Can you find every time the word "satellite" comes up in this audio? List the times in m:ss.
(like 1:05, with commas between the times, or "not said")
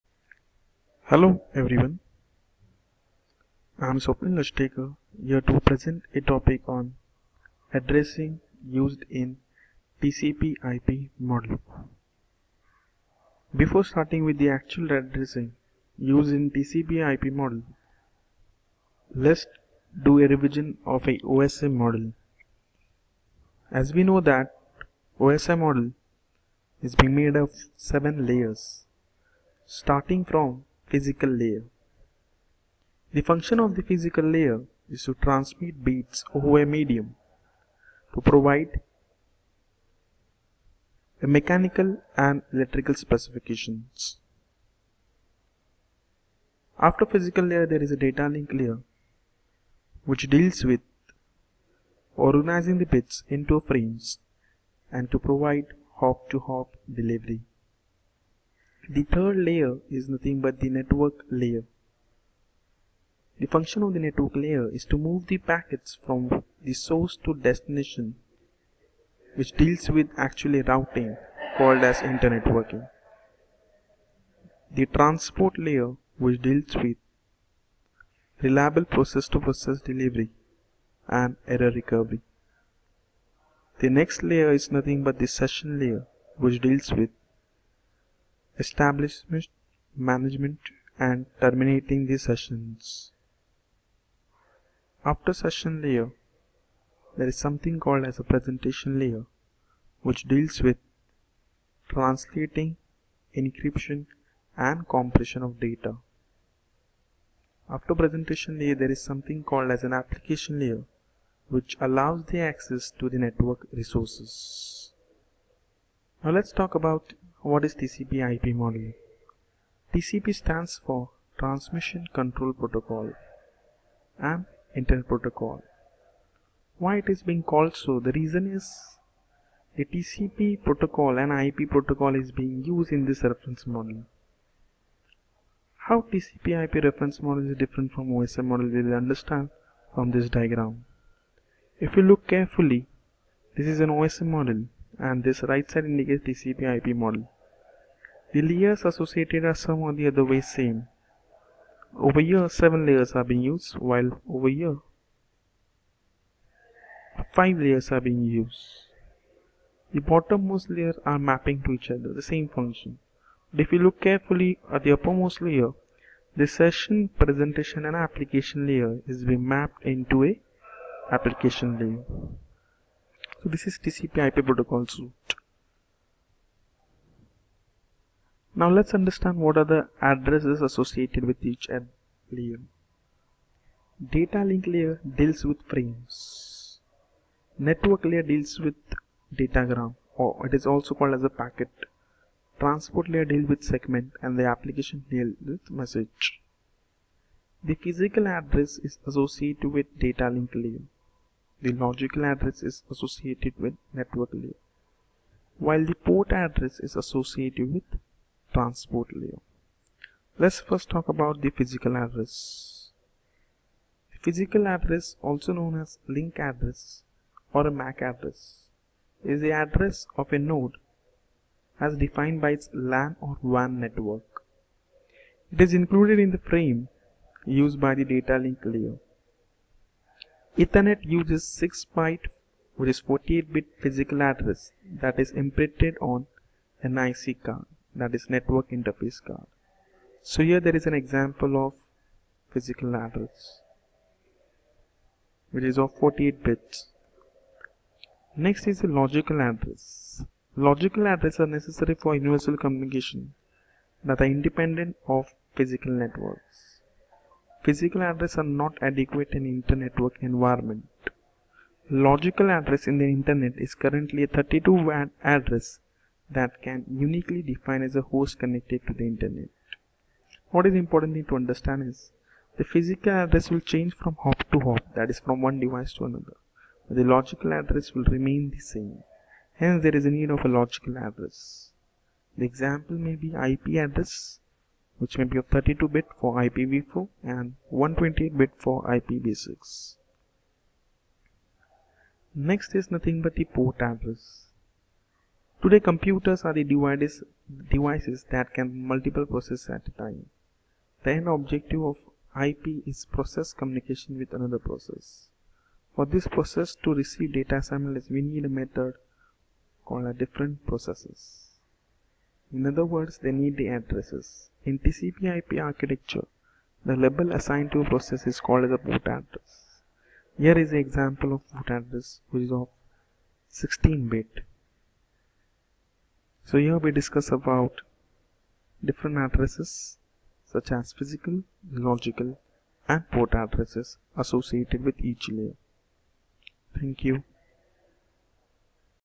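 not said.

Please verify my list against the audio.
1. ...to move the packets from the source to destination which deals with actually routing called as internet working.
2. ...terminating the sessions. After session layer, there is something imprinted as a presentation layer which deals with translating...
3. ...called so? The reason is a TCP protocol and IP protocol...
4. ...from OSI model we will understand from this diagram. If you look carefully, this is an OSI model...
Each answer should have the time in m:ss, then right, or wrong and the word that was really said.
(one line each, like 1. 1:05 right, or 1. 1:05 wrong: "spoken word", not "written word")
1. 1:04 right
2. 1:31 wrong: "called", not "imprinted"
3. 2:07 right
4. 2:17 right.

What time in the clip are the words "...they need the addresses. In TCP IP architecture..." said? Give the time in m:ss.
5:13.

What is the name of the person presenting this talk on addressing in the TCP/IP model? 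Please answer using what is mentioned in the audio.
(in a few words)
Swapnil Ashtekar.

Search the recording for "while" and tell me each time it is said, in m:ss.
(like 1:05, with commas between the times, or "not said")
2:33, 3:25.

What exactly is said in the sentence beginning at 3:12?
Transport layer deals with segment and the application deals with message.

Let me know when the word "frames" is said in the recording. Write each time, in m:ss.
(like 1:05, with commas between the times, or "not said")
0:53, 3:05, 3:46.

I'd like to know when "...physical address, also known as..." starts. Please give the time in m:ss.
3:34.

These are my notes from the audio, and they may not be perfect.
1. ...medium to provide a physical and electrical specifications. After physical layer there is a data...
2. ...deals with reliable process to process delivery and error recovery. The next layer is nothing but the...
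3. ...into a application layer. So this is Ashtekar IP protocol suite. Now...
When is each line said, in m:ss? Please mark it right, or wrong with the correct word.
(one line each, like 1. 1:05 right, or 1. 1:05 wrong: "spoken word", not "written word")
1. 0:36 wrong: "mechanical", not "physical"
2. 1:16 right
3. 2:49 wrong: "TCP", not "Ashtekar".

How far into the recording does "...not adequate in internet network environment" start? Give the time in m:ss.
4:18.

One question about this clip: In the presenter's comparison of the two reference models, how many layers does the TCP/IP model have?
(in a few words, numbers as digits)
5.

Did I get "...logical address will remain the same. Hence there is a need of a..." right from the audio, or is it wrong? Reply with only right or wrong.
right.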